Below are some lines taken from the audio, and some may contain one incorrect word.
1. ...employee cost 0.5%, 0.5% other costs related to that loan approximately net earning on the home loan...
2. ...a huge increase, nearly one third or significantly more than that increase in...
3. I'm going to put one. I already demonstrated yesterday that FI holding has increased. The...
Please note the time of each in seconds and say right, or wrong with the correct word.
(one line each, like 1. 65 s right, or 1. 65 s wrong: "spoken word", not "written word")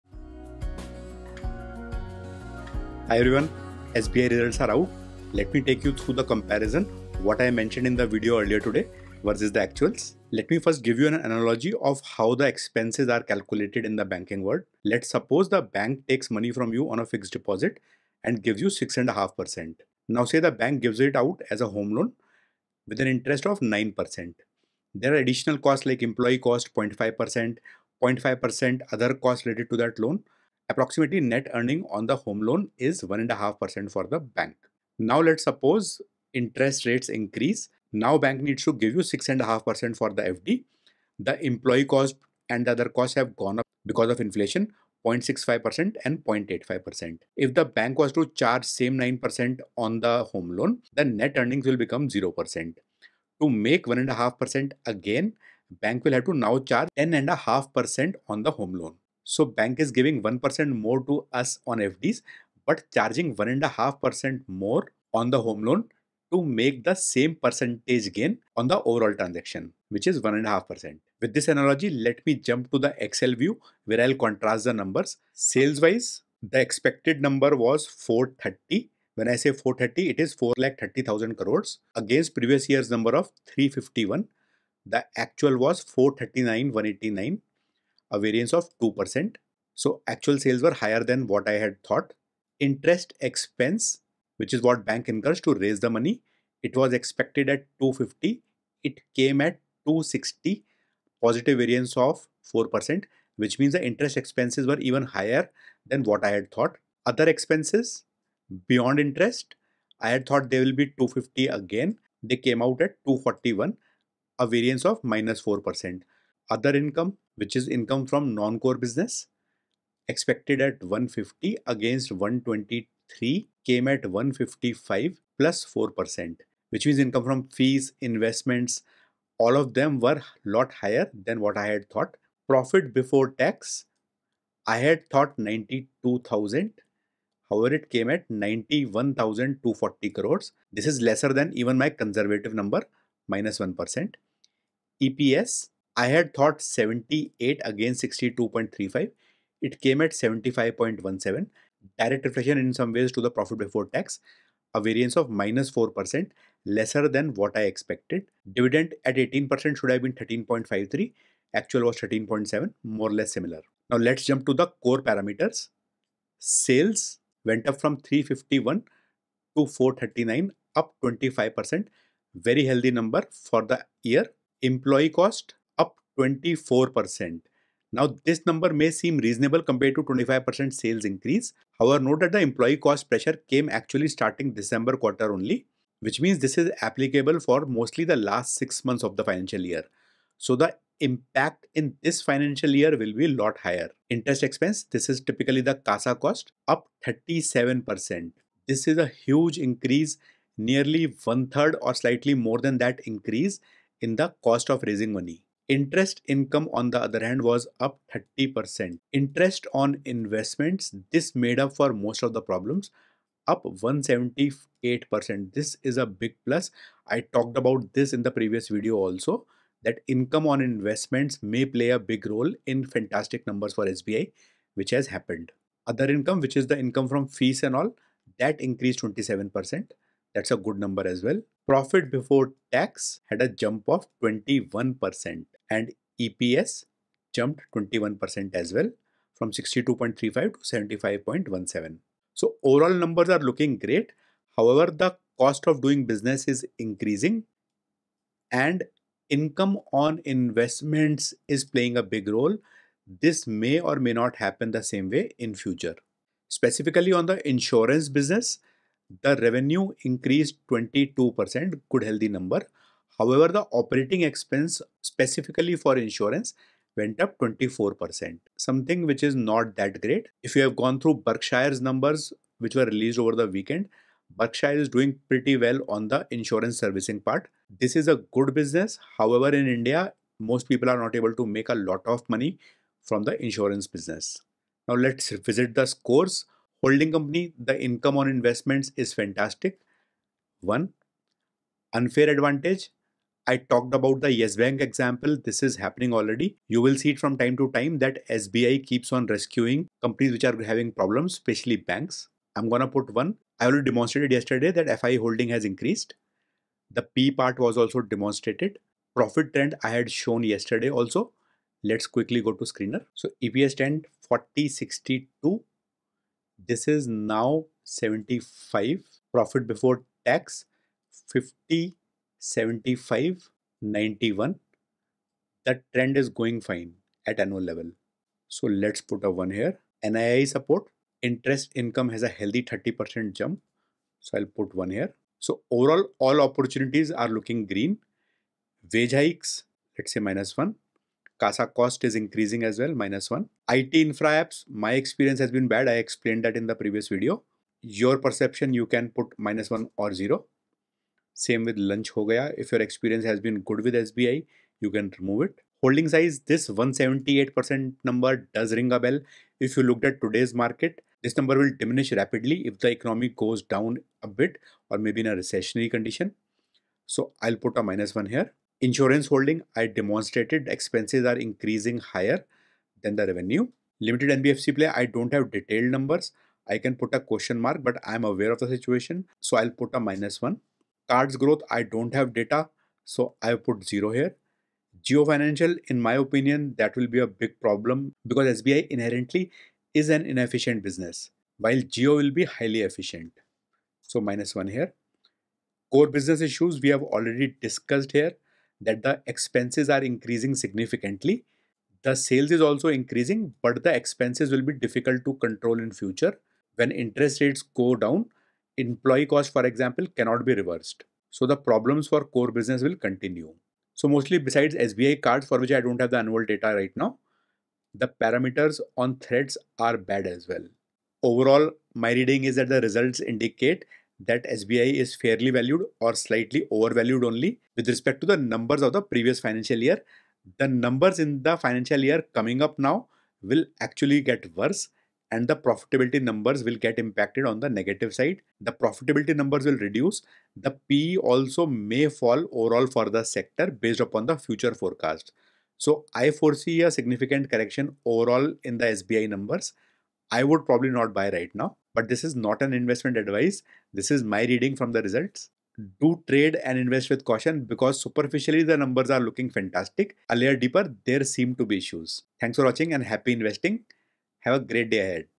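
1. 26 s right
2. 198 s wrong: "slightly", not "significantly"
3. 302 s right.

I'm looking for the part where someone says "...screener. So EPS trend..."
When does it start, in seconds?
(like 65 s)
312 s.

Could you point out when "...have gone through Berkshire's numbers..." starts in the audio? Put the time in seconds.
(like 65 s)
270 s.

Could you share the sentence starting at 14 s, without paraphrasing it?
Let's suppose the bank takes money from you on a fixed deposit and gives you 6.5%.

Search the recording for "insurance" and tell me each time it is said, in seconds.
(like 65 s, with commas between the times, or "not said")
257 s, 265 s, 276 s, 283 s, 368 s.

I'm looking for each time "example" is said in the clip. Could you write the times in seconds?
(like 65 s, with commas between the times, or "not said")
294 s, 409 s.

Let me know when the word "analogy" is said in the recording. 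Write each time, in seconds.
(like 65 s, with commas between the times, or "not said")
11 s, 71 s.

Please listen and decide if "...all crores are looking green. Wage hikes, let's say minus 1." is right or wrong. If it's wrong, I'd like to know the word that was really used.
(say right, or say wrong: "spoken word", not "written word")
wrong: "opportunities", not "crores".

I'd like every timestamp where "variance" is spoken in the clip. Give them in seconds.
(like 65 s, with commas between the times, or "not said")
88 s, 101 s, 114 s, 154 s.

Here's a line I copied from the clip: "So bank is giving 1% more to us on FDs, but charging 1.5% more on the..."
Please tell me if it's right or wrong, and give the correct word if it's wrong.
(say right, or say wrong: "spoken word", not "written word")
right.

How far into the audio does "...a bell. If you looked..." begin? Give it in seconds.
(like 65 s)
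358 s.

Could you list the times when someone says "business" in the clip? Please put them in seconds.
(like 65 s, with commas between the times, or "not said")
118 s, 246 s, 258 s, 278 s, 283 s, 390 s, 396 s, 412 s.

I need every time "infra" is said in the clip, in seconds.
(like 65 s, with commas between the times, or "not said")
343 s.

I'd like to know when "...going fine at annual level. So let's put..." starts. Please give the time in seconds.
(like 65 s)
326 s.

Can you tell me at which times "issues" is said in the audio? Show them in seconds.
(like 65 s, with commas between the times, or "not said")
396 s, 461 s.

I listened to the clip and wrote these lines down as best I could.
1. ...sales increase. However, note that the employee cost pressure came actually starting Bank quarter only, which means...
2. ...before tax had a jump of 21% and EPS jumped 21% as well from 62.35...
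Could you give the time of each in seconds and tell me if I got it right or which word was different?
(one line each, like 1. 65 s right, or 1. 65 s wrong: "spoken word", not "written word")
1. 180 s wrong: "December", not "Bank"
2. 232 s right.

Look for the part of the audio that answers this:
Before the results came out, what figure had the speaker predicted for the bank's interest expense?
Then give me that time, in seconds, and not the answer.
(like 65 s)
96 s.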